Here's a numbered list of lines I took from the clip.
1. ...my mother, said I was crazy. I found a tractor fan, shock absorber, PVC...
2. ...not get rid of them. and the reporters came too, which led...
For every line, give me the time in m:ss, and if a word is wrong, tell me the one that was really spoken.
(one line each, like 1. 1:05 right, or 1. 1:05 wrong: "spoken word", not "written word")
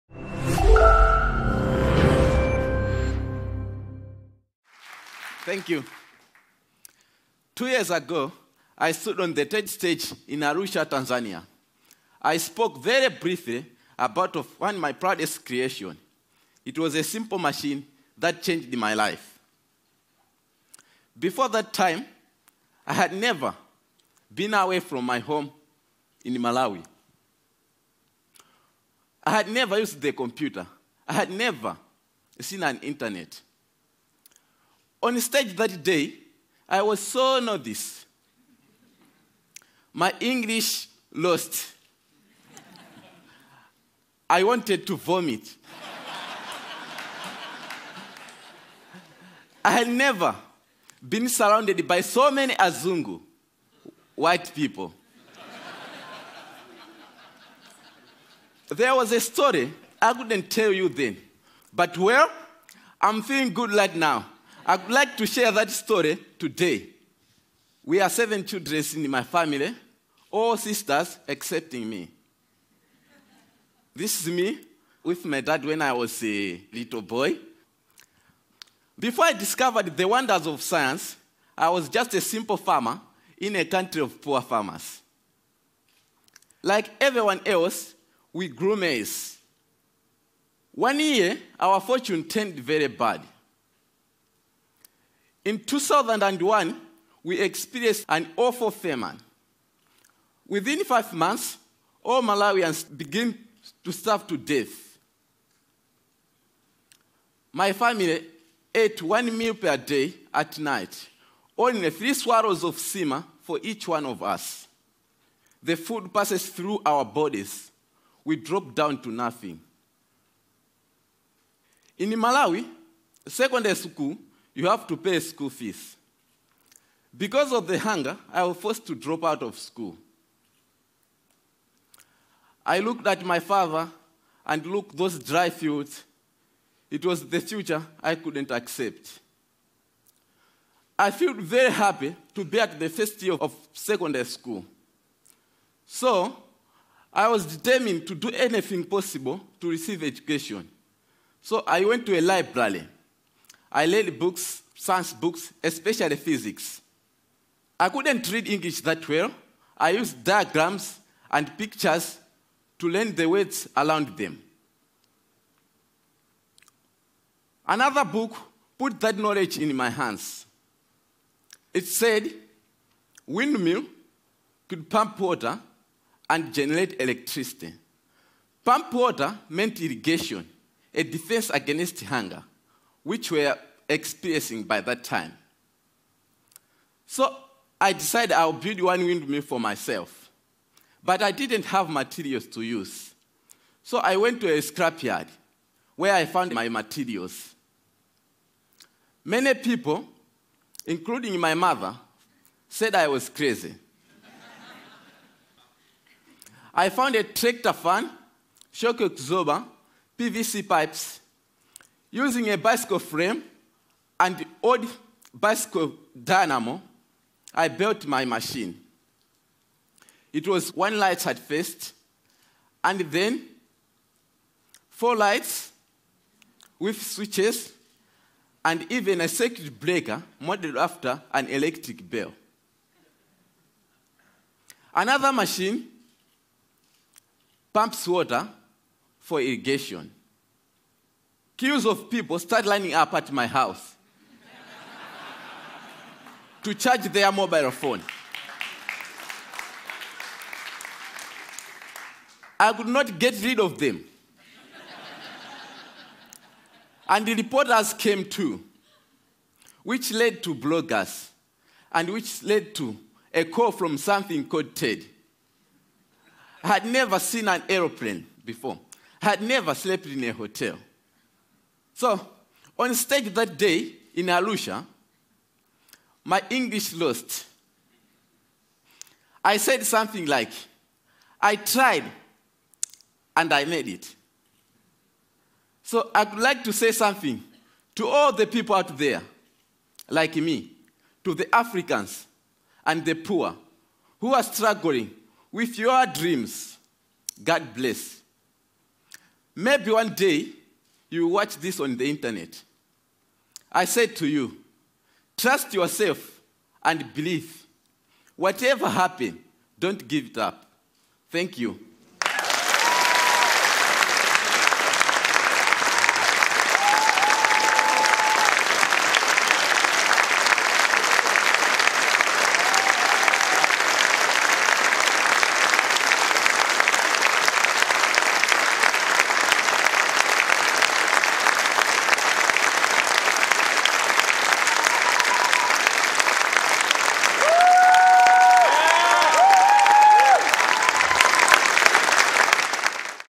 1. 3:21 right
2. 4:12 right.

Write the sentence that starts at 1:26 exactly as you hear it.
Like everyone else, we grew maize.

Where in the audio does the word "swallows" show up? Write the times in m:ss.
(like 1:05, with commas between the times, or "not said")
1:52.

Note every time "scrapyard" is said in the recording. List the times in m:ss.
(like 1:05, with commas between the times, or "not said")
3:14.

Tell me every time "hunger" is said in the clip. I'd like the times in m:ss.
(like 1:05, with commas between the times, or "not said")
2:07, 3:02.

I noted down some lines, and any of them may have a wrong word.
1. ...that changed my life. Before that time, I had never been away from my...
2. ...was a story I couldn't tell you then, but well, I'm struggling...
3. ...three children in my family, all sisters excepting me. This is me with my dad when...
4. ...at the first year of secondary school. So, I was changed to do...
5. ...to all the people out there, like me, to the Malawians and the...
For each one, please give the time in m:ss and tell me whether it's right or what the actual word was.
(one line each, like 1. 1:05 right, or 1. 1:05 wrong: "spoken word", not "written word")
1. 0:18 right
2. 0:58 wrong: "feeling", not "struggling"
3. 1:08 wrong: "seven", not "three"
4. 2:22 wrong: "determined", not "changed"
5. 4:47 wrong: "Africans", not "Malawians".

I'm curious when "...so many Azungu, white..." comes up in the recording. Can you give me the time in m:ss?
0:52.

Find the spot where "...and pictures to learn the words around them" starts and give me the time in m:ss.
2:41.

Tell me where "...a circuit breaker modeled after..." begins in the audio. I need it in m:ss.
3:49.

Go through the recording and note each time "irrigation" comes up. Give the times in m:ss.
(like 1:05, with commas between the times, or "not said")
2:59, 3:59.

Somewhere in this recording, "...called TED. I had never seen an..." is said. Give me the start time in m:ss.
4:24.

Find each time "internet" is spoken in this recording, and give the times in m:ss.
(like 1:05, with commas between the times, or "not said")
0:32, 5:02.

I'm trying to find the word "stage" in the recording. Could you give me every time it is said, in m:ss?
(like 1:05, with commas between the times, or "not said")
0:09, 0:35, 4:32.